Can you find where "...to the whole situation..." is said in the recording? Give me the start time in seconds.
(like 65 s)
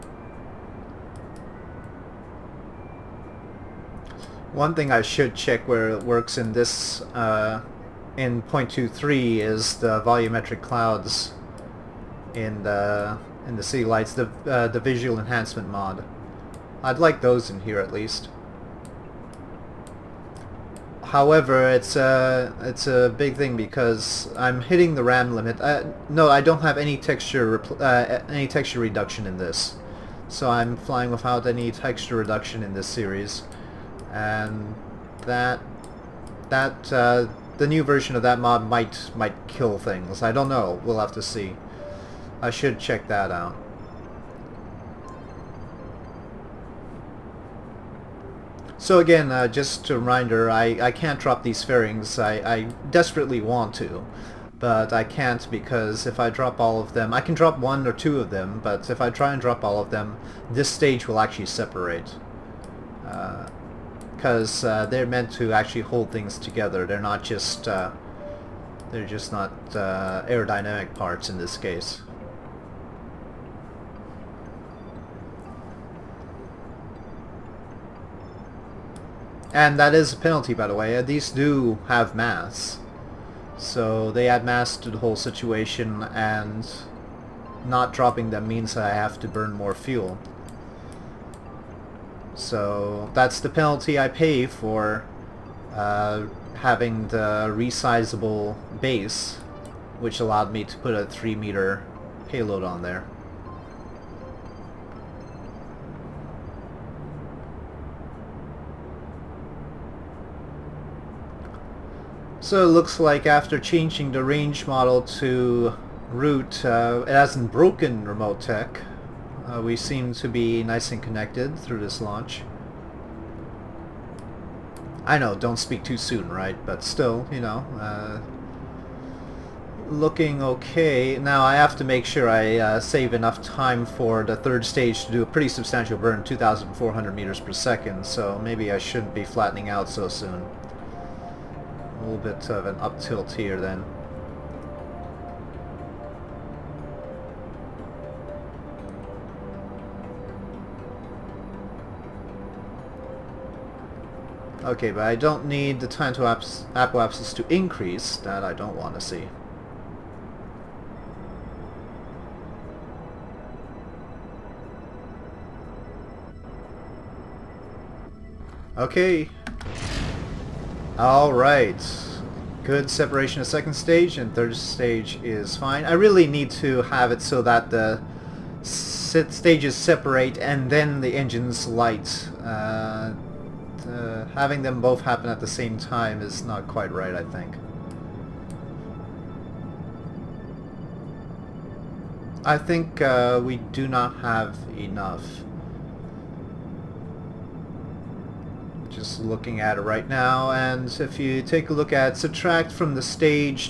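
84 s.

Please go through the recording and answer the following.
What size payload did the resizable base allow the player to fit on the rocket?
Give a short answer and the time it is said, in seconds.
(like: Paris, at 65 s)
3 meter, at 101 s.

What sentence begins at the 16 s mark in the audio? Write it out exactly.
I'd like those in here at least.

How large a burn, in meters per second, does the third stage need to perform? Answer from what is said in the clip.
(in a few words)
2400.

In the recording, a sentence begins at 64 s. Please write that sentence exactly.
Because uh, uh, they're meant to actually hold things together.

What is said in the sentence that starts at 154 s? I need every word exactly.
Okay, but I don't need the time to apps, apoapsis to increase.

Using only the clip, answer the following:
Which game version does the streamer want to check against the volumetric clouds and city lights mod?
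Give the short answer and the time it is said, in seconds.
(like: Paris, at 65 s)
.23, at 8 s.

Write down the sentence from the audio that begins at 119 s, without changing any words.
Uh, we seem to be nice and connected through this launch.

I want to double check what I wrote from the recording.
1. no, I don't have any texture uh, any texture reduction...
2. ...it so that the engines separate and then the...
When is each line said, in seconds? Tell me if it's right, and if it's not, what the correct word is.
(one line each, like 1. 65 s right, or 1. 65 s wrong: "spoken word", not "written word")
1. 26 s right
2. 177 s wrong: "stages", not "engines".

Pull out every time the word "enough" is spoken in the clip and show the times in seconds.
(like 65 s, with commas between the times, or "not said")
133 s, 194 s.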